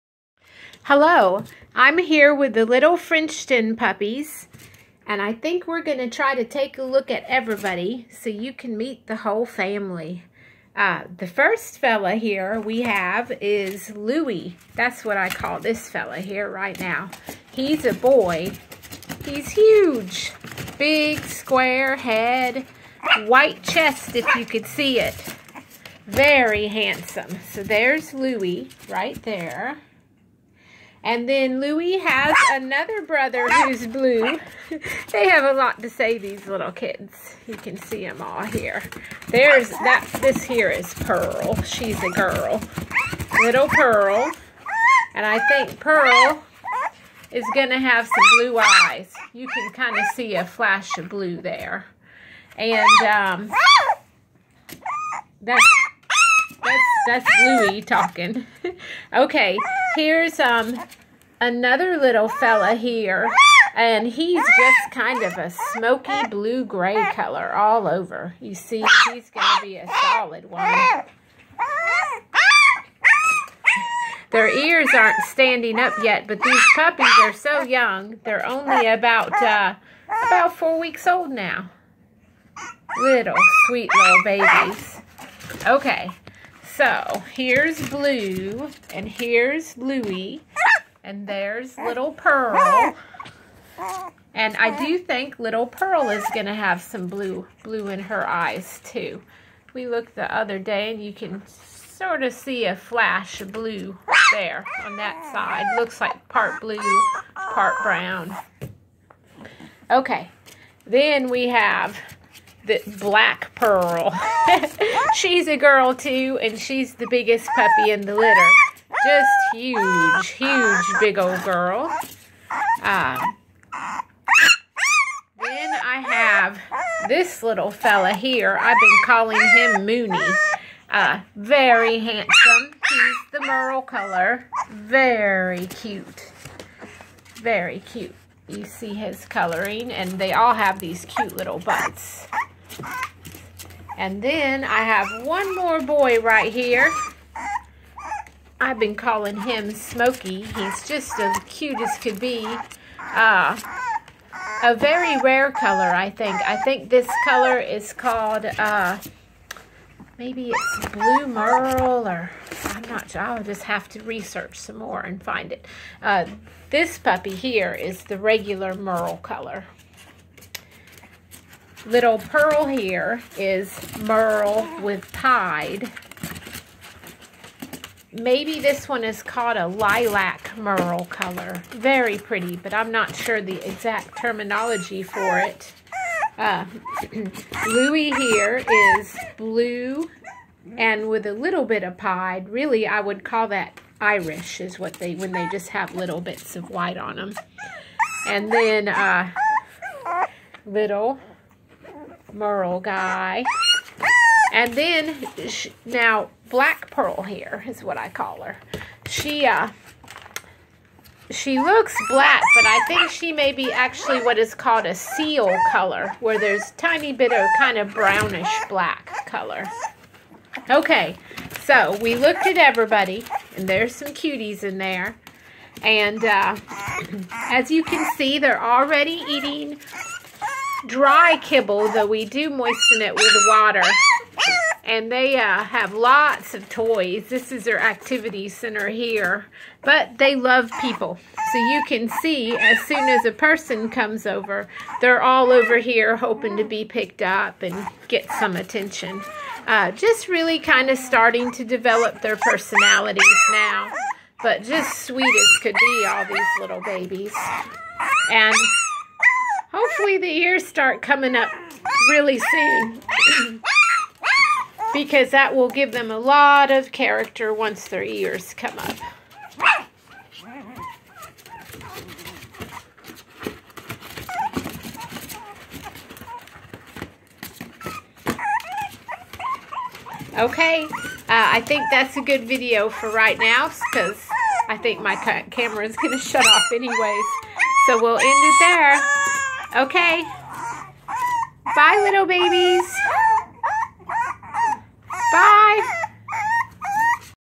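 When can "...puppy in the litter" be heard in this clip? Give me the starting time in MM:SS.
01:57.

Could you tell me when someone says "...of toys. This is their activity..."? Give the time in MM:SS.
03:56.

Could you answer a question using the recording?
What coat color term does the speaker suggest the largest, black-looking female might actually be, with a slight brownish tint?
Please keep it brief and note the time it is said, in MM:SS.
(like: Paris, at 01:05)
Seal, at 03:34.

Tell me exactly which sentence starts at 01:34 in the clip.
And I do think Little Pearl is going to have some blue, blue in her eyes, too.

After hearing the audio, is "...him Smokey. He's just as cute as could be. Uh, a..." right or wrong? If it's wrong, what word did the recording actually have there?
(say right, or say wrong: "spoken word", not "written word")
right.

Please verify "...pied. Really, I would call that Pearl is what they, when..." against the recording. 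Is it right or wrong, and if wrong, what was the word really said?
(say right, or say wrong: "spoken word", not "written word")
wrong: "Irish", not "Pearl".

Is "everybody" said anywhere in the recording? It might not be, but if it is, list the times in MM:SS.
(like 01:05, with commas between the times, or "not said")
00:07, 03:42.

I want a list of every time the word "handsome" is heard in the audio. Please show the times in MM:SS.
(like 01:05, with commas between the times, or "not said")
00:26, 02:11.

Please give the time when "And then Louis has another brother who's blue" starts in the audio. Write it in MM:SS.
00:31.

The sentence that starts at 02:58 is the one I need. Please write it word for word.
Maybe this one is called a lilac merle color.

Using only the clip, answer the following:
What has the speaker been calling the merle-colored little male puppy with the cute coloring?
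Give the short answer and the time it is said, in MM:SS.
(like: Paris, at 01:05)
Mooney, at 02:09.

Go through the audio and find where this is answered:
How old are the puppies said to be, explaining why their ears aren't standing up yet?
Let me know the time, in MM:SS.
01:20.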